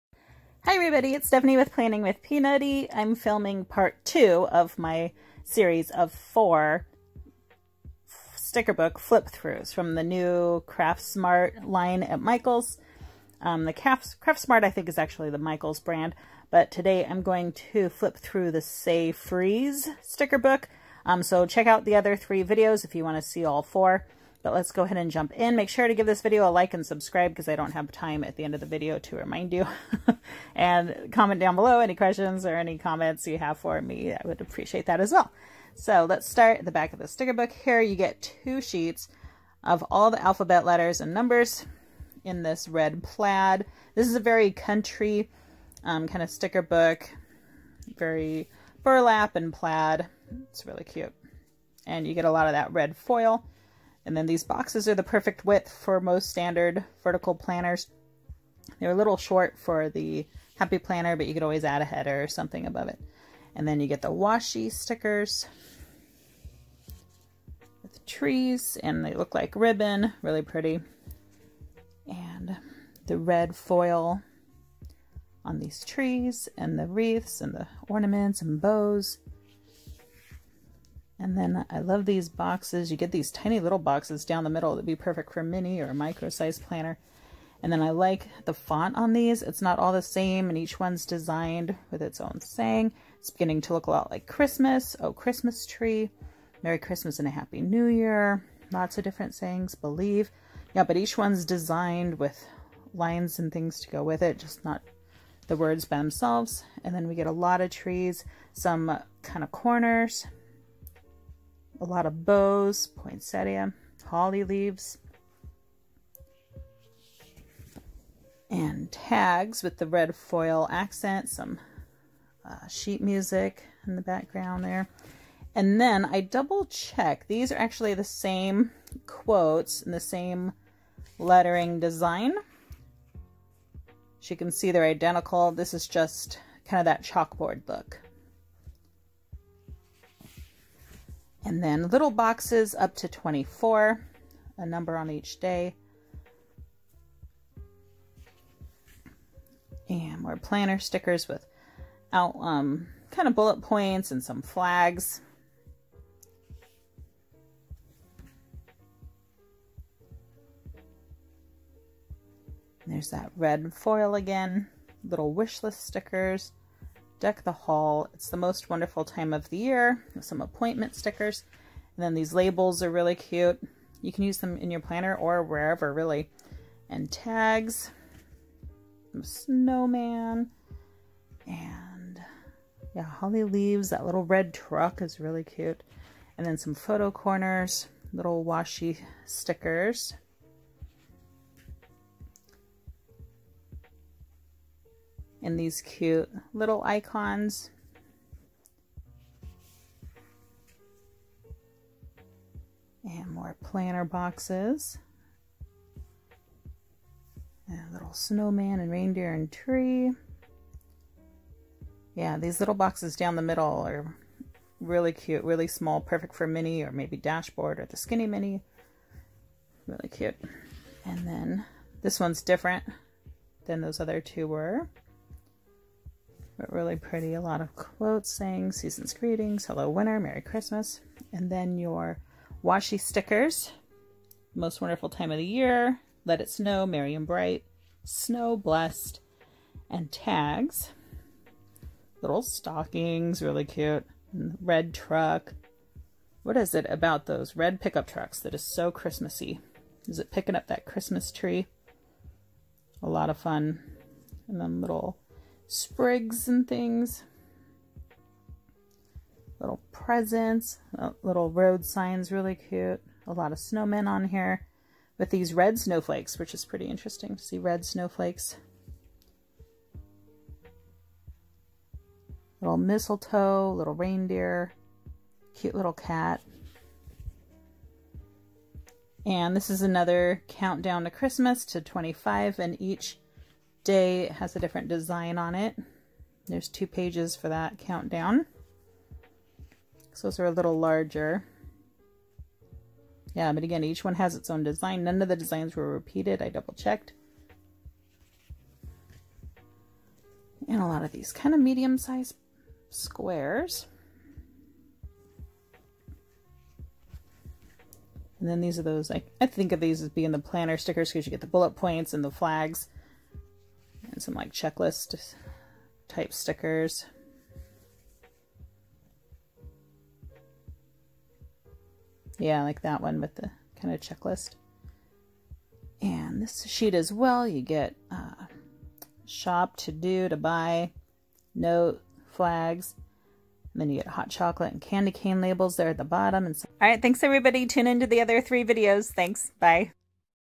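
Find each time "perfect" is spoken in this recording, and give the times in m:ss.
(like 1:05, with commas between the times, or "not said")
0:55, 1:24, 3:36.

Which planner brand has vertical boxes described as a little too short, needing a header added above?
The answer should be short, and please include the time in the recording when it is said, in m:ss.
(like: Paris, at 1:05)
Happy Planner, at 1:00.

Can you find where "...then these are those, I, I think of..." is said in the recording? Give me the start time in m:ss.
5:08.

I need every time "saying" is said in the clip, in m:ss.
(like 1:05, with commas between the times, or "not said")
1:32, 1:39, 3:48.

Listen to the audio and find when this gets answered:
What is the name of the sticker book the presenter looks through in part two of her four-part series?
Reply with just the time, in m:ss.
0:18.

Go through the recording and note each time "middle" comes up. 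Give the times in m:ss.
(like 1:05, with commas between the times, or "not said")
1:24, 3:33.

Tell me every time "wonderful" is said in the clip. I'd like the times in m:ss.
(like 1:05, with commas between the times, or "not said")
2:48, 3:54.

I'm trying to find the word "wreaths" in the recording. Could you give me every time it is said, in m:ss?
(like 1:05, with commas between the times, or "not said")
1:16.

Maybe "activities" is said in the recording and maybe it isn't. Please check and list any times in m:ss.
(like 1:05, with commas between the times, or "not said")
not said.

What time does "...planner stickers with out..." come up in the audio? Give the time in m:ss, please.
2:30.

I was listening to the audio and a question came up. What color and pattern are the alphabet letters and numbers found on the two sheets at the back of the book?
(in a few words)
Red plaid.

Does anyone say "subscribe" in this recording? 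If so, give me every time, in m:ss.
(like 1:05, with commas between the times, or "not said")
0:26.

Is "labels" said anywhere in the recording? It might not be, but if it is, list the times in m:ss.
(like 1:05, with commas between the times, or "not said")
2:52, 5:35.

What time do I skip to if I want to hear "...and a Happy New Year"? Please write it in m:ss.
1:37.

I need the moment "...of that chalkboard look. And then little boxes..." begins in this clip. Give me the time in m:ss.
2:16.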